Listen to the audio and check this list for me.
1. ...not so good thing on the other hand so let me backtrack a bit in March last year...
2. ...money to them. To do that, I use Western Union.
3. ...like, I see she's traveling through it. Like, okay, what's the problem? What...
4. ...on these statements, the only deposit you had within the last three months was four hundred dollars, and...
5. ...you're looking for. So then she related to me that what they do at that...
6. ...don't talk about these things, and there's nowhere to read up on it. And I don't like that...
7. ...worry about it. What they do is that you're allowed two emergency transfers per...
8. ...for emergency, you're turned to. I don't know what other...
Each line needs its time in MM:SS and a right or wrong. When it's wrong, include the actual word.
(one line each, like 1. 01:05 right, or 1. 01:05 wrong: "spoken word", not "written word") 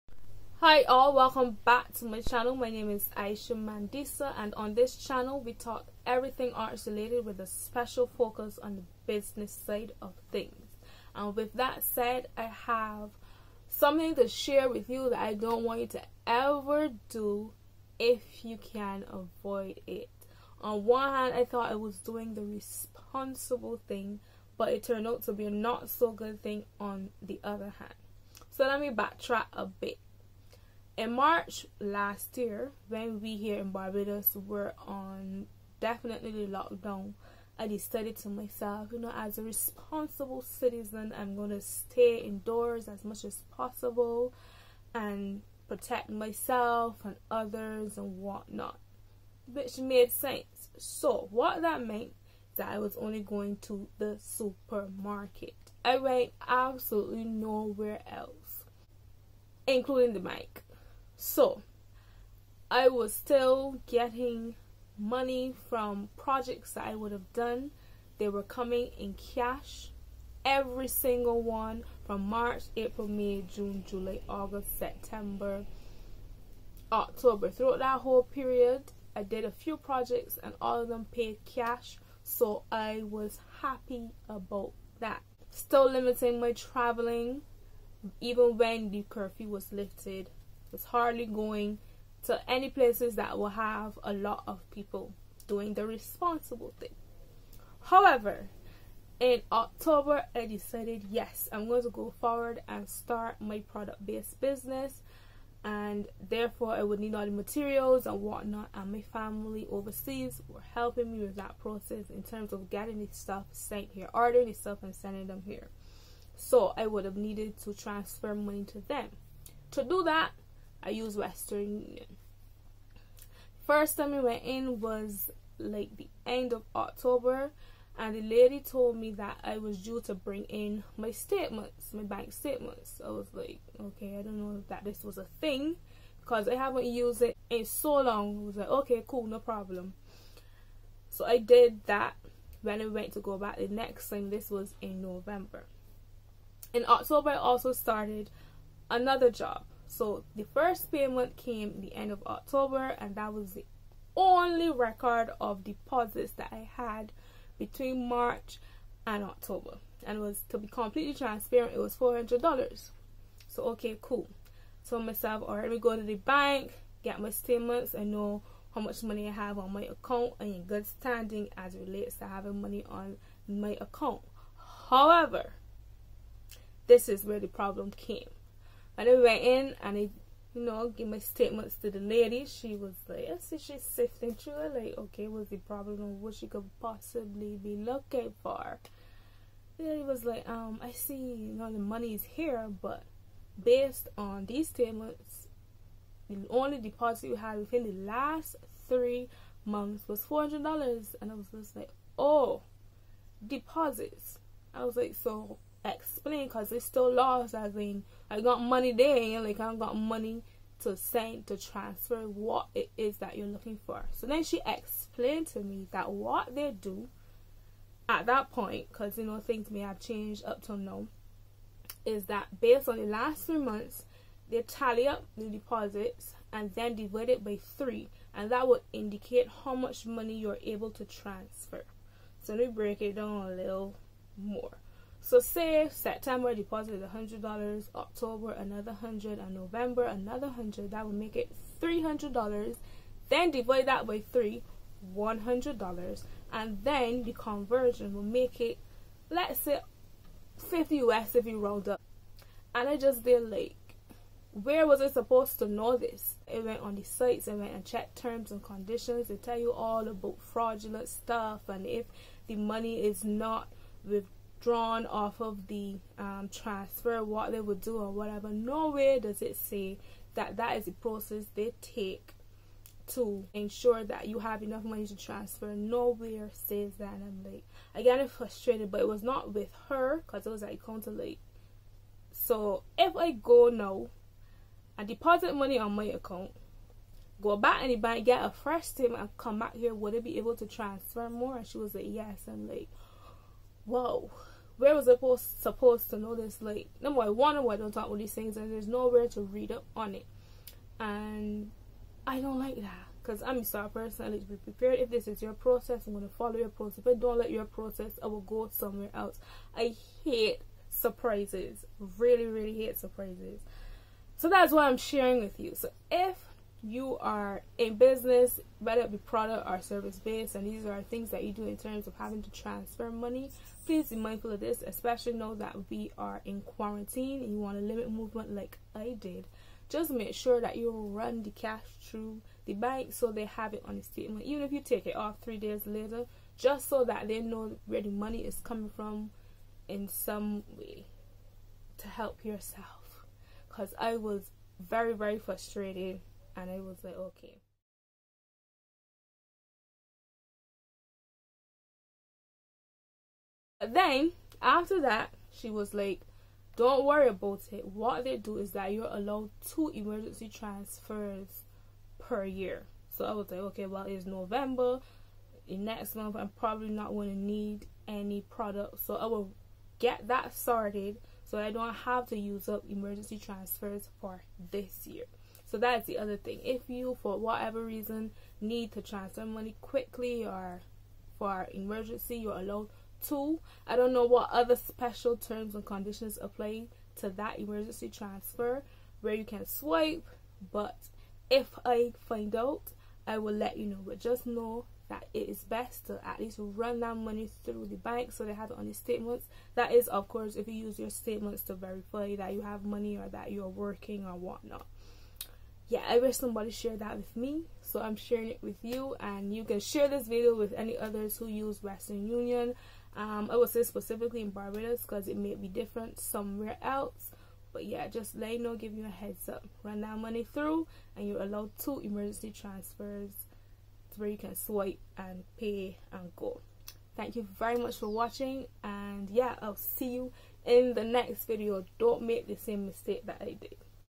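1. 00:25 right
2. 01:58 right
3. 03:03 wrong: "sifting", not "traveling"
4. 03:14 right
5. 03:33 wrong: "explained", not "related"
6. 04:57 right
7. 05:57 right
8. 06:21 wrong: "allowed", not "turned".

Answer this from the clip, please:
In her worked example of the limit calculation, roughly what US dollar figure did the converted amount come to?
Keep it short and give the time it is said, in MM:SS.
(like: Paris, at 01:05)
50 US, at 04:10.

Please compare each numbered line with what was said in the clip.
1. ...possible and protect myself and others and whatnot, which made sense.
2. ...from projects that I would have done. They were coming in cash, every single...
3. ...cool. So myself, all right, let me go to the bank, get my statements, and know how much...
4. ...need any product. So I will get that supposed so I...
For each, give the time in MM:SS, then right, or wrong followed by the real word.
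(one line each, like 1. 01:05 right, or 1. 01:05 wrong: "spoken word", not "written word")
1. 00:43 right
2. 01:05 right
3. 02:44 right
4. 06:07 wrong: "sorted", not "supposed".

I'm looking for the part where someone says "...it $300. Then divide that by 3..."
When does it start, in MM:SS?
04:01.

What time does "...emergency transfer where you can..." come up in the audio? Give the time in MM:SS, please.
06:27.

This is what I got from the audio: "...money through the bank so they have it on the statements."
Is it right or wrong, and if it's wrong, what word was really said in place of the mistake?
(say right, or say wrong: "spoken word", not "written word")
right.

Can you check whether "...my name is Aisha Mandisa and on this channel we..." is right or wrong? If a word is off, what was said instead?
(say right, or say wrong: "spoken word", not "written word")
right.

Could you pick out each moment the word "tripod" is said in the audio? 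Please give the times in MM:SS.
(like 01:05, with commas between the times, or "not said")
not said.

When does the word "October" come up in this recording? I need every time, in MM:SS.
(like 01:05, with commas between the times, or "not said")
01:16, 01:39, 02:06, 02:26, 02:32, 02:39, 03:57.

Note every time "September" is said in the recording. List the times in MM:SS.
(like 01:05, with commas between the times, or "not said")
01:14, 03:55.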